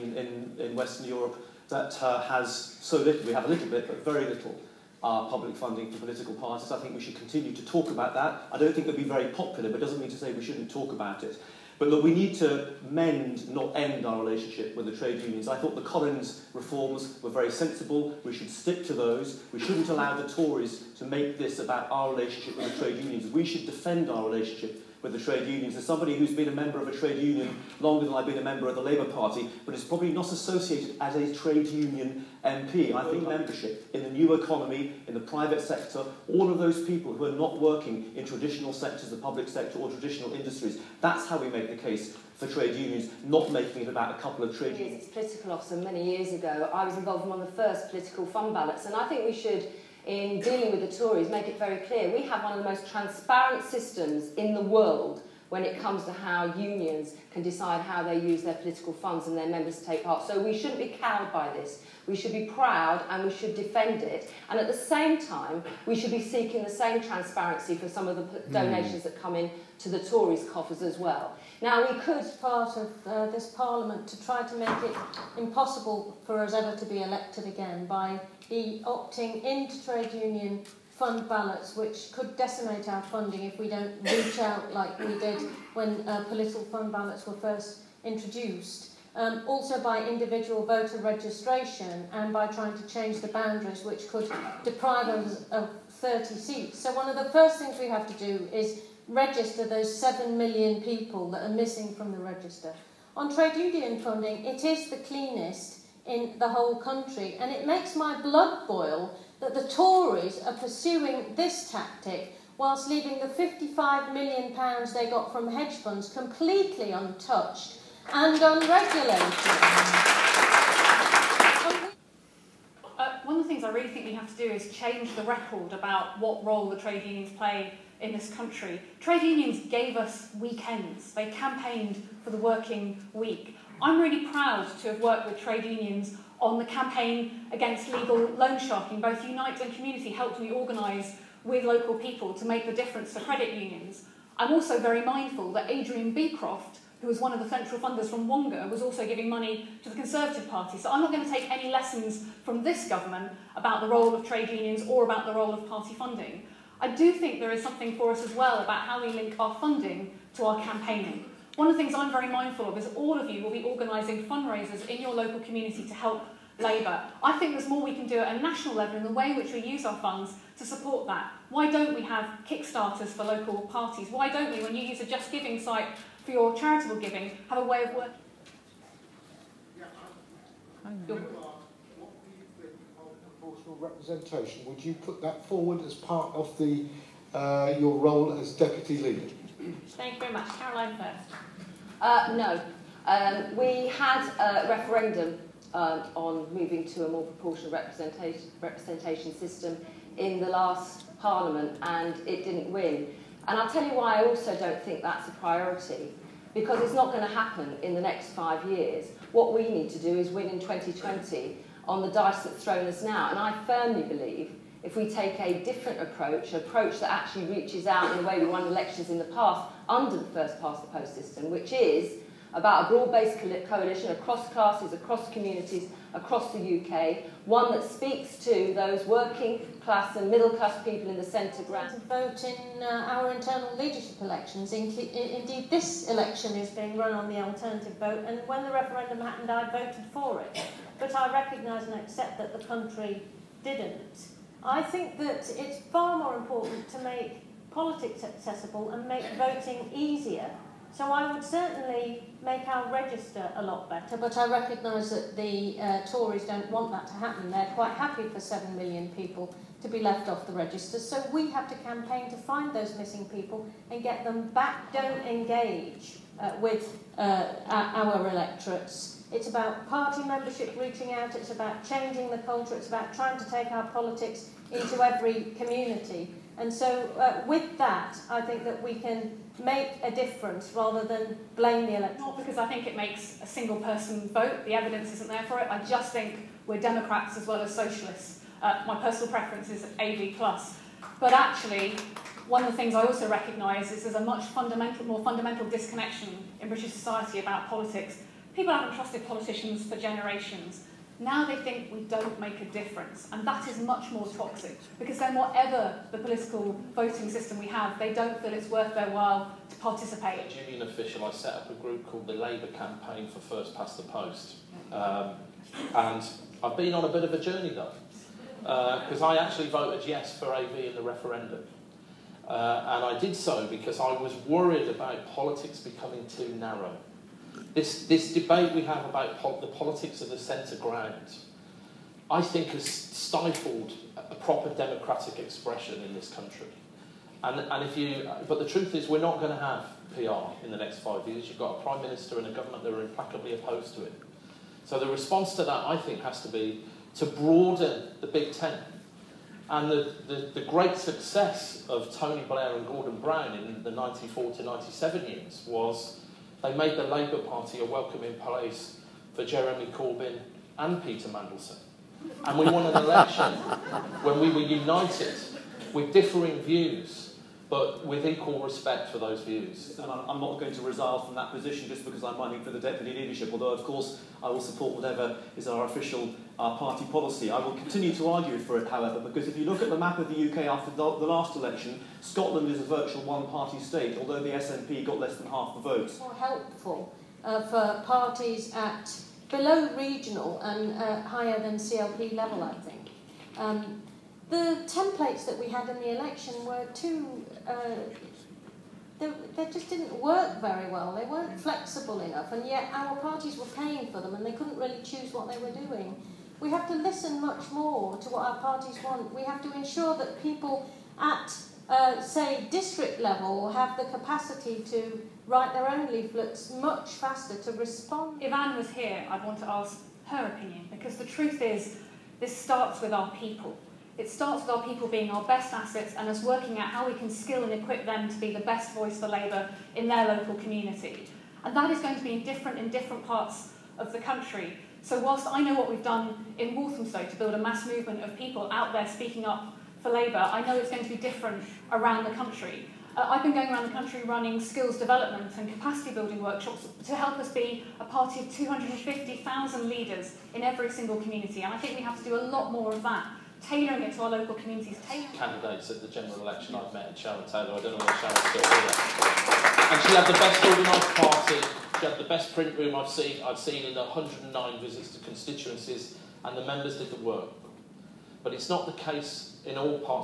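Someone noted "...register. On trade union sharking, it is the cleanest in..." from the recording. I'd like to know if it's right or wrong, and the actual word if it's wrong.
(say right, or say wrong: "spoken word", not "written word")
wrong: "funding", not "sharking".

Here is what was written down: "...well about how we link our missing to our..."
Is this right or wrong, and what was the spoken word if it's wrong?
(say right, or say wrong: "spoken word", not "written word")
wrong: "funding", not "missing".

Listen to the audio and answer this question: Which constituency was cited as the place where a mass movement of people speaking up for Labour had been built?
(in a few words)
Walthamstow.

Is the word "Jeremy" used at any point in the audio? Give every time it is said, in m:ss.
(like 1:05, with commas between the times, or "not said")
5:59.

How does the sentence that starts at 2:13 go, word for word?
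I'm really proud to have worked with trade unions on the campaign against legal loan sharking.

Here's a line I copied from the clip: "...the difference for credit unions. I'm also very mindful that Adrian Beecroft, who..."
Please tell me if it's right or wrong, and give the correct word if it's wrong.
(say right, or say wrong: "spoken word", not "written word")
right.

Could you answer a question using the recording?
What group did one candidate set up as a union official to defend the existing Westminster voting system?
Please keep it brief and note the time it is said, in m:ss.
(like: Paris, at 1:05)
Labour Campaign for First Past the Post, at 5:12.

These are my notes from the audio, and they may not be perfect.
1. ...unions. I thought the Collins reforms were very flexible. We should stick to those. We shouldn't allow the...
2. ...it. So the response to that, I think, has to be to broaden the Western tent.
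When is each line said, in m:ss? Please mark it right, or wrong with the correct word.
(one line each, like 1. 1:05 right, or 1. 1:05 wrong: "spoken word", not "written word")
1. 0:15 wrong: "sensible", not "flexible"
2. 5:44 wrong: "Big", not "Western".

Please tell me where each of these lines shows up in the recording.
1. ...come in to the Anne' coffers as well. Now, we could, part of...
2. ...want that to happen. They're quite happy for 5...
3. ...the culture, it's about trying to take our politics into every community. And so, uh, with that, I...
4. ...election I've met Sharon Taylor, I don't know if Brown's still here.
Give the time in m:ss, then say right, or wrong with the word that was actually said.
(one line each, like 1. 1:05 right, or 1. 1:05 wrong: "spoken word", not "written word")
1. 1:09 wrong: "Tories", not "Anne"
2. 4:16 wrong: "7", not "5"
3. 4:32 right
4. 7:36 wrong: "Sharon", not "Brown".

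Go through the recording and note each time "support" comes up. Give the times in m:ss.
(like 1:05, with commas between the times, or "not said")
2:50, 6:14.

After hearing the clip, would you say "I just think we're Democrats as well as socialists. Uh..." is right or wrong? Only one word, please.
right.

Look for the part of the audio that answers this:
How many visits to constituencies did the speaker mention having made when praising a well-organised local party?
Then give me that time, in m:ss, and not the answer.
7:44.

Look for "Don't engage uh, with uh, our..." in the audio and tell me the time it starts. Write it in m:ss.
4:24.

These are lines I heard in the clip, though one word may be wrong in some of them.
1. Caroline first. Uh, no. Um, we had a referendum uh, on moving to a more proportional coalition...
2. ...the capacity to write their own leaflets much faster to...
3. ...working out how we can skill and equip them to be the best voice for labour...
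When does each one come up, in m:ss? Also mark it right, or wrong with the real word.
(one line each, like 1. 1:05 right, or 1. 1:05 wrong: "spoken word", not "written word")
1. 3:10 wrong: "representation", not "coalition"
2. 6:53 right
3. 7:06 right.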